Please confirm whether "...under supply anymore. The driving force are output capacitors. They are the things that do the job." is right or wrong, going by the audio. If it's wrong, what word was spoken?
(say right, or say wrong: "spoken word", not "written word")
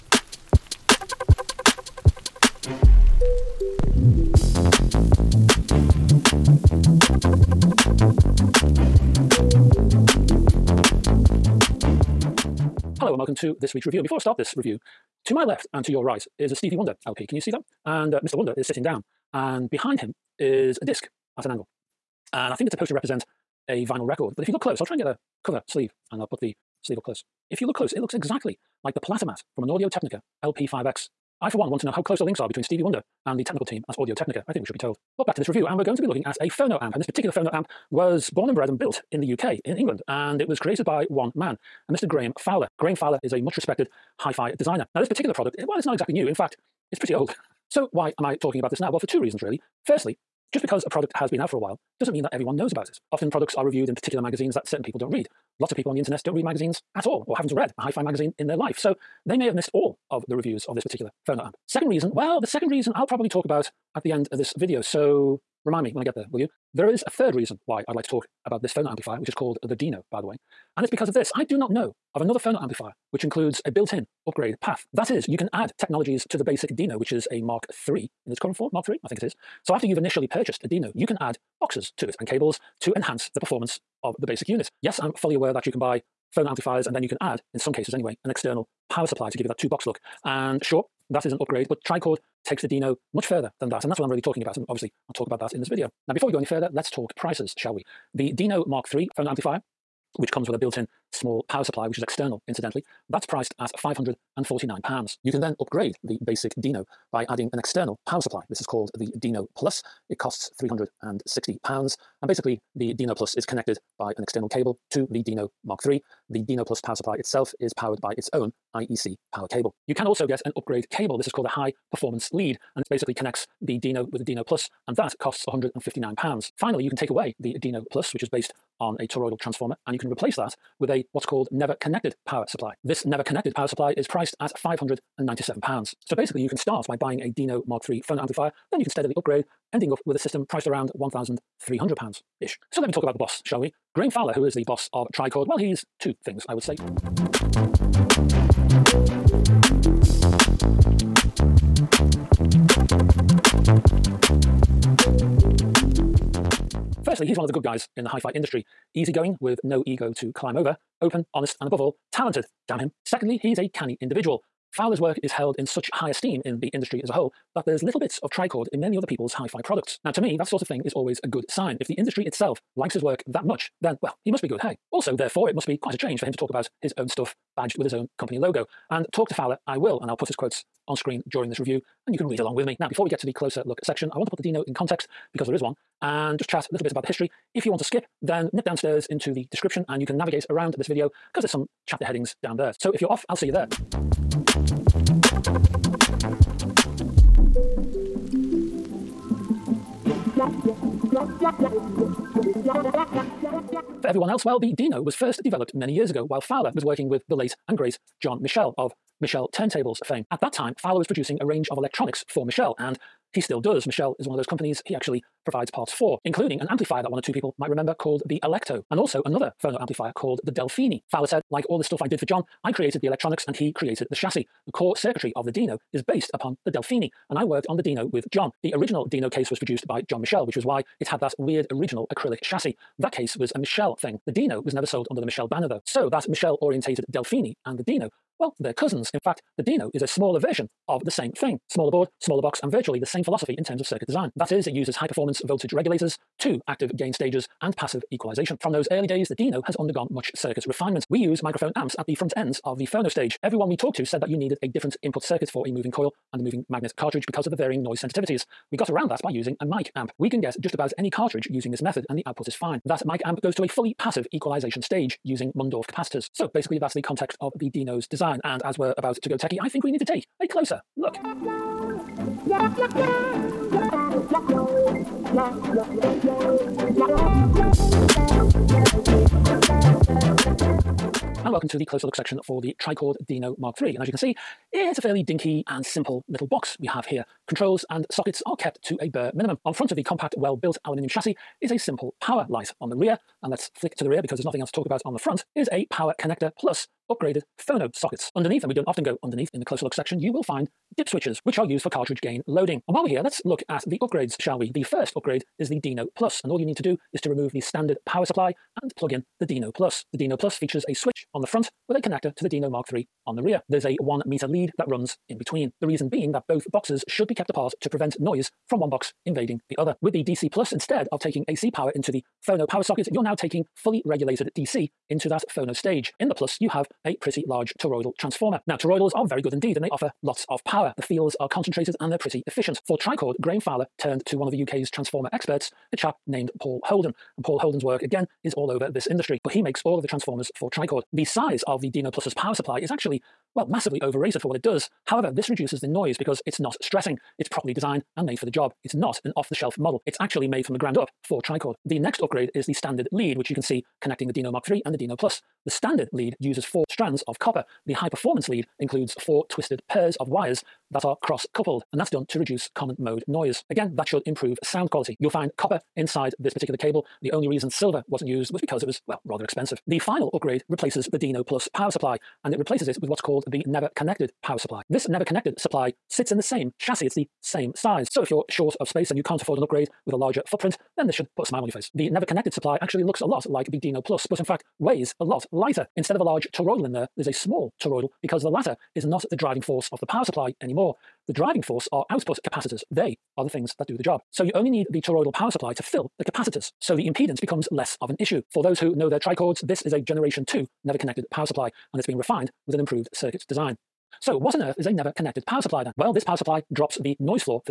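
wrong: "power", not "under".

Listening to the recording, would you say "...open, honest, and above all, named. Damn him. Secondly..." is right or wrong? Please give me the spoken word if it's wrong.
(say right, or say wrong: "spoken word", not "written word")
wrong: "talented", not "named".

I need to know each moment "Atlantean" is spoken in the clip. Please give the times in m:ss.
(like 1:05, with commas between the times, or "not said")
not said.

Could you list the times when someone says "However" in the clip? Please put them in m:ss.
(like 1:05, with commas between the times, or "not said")
5:45.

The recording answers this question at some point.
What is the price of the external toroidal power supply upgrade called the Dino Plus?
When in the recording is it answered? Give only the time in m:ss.
1:50.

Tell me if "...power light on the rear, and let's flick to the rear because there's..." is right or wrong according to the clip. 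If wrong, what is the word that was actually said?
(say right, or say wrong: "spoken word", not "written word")
right.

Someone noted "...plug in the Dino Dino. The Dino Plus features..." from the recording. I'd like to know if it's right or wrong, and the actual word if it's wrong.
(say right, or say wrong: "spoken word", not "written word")
wrong: "Plus", not "Dino".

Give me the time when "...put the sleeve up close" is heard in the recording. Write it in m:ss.
0:26.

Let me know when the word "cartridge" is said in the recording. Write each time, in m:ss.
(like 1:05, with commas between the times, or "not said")
4:16, 4:21, 5:01.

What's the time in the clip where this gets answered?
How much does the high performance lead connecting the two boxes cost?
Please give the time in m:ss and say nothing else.
2:05.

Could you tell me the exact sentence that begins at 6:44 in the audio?
So what on earth is a never connected power supply then?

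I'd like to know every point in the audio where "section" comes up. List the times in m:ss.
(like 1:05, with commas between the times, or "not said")
3:03, 4:42, 4:59.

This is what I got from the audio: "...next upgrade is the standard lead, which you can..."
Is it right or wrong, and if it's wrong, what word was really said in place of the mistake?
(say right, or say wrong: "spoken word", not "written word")
right.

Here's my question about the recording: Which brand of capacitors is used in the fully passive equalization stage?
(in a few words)
Mundorf.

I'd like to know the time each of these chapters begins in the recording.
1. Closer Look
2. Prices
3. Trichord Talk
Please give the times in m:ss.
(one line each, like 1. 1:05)
1. 4:30
2. 1:36
3. 2:26.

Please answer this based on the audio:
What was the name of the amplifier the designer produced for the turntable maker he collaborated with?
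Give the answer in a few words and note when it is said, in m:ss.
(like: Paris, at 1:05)
Alecto, at 3:38.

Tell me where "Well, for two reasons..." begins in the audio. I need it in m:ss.
0:48.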